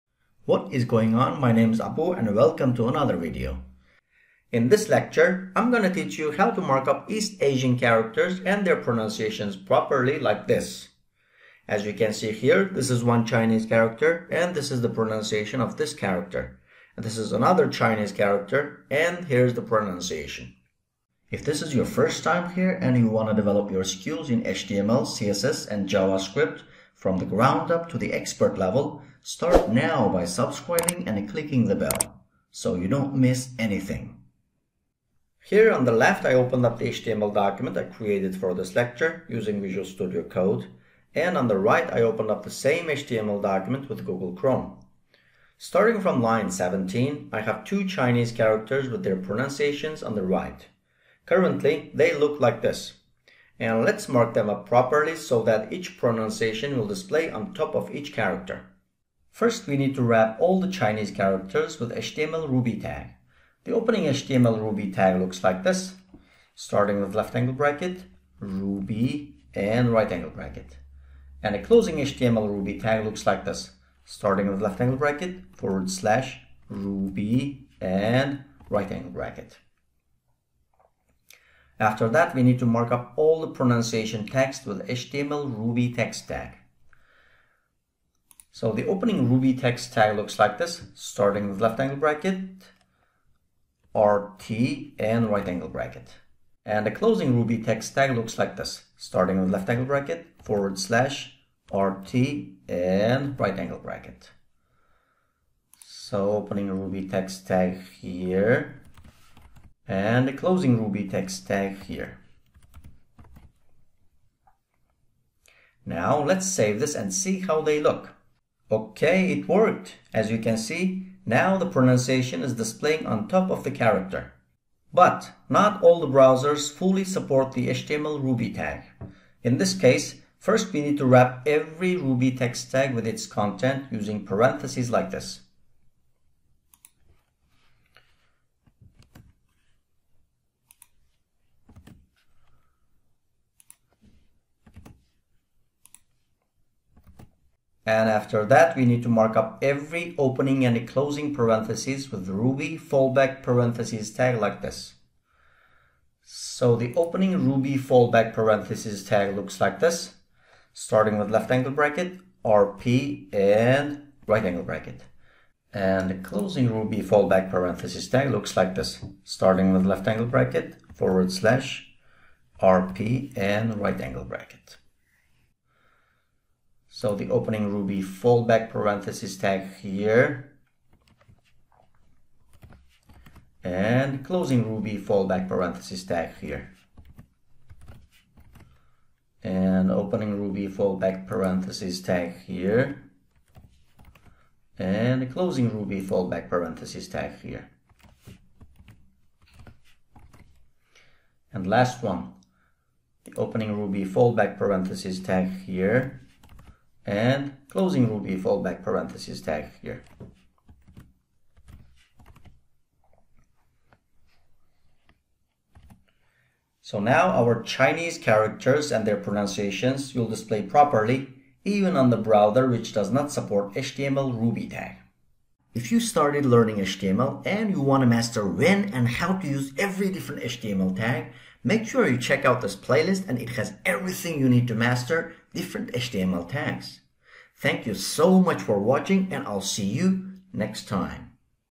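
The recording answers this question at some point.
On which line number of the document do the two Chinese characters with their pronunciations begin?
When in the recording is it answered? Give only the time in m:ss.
0:46.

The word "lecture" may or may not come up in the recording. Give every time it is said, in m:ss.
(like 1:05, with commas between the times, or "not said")
0:04, 0:38.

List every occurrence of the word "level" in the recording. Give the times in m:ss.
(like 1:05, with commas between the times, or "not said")
0:28.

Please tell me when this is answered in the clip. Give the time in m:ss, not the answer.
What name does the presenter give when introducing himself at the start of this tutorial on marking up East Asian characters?
0:01.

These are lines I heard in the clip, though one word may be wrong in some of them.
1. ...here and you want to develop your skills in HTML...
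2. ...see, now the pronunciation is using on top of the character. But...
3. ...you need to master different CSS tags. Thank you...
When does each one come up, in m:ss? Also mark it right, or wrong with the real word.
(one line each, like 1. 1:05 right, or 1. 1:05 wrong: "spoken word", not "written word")
1. 0:22 right
2. 2:00 wrong: "displaying", not "using"
3. 3:54 wrong: "HTML", not "CSS".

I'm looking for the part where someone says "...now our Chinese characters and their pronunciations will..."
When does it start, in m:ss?
3:36.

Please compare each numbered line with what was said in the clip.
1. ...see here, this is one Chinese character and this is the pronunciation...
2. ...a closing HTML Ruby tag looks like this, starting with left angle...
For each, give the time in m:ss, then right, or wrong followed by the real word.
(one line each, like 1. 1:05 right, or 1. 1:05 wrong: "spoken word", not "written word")
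1. 0:12 right
2. 1:11 right.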